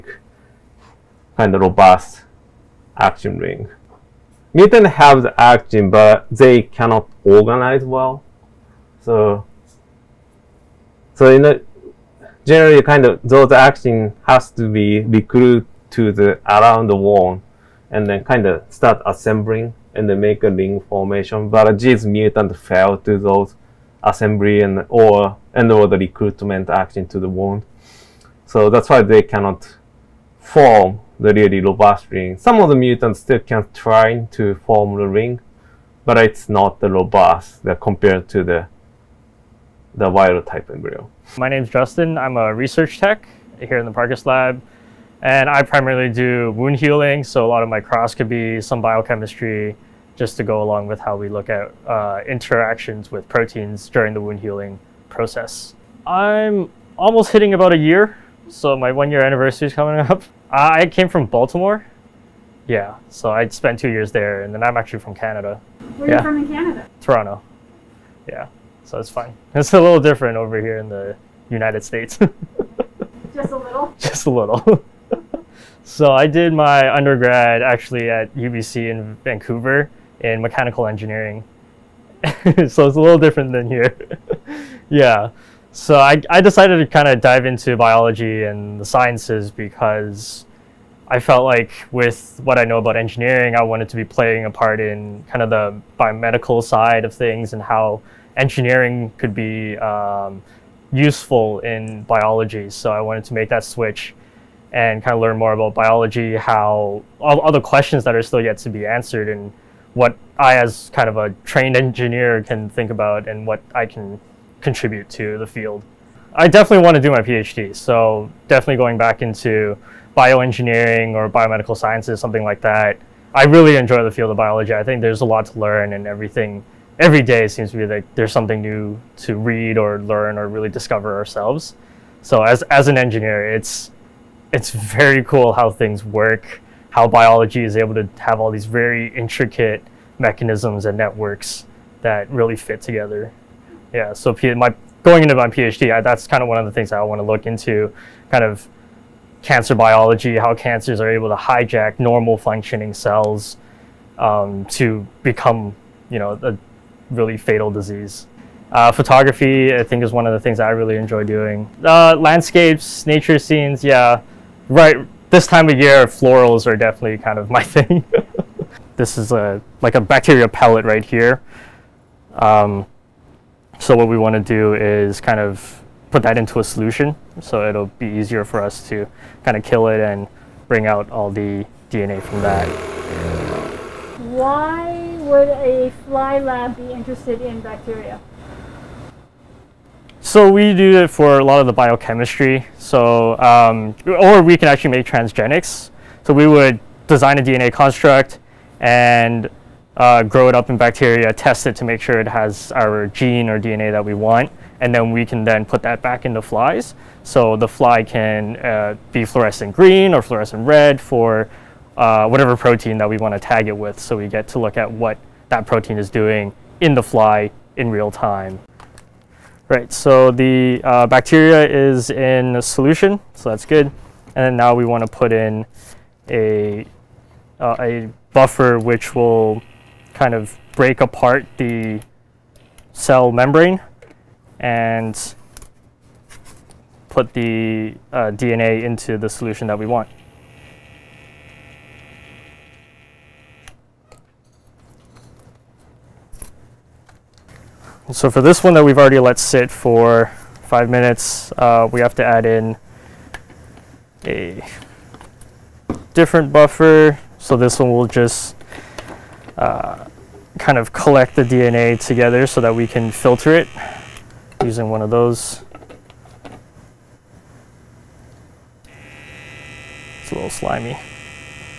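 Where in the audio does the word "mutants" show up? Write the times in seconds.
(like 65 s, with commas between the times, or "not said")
4 s, 22 s, 32 s.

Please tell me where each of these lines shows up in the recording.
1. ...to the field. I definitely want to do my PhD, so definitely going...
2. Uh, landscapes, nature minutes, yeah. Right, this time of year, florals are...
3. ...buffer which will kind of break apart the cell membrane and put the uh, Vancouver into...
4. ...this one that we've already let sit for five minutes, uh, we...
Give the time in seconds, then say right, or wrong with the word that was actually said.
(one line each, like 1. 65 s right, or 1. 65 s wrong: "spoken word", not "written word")
1. 115 s right
2. 161 s wrong: "scenes", not "minutes"
3. 228 s wrong: "DNA", not "Vancouver"
4. 248 s right.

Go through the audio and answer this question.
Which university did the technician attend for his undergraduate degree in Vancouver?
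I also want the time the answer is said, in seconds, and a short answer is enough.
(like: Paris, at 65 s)
UBC, at 78 s.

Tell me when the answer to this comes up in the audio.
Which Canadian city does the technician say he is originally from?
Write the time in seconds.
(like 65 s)
67 s.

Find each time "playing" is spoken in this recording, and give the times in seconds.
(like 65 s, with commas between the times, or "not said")
94 s.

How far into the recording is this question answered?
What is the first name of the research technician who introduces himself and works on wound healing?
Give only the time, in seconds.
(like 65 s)
41 s.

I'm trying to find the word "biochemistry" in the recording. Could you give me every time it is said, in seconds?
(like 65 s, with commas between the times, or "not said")
48 s, 191 s.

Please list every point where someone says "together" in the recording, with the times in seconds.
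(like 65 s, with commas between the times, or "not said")
142 s, 261 s.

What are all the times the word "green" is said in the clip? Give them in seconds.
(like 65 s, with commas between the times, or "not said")
209 s.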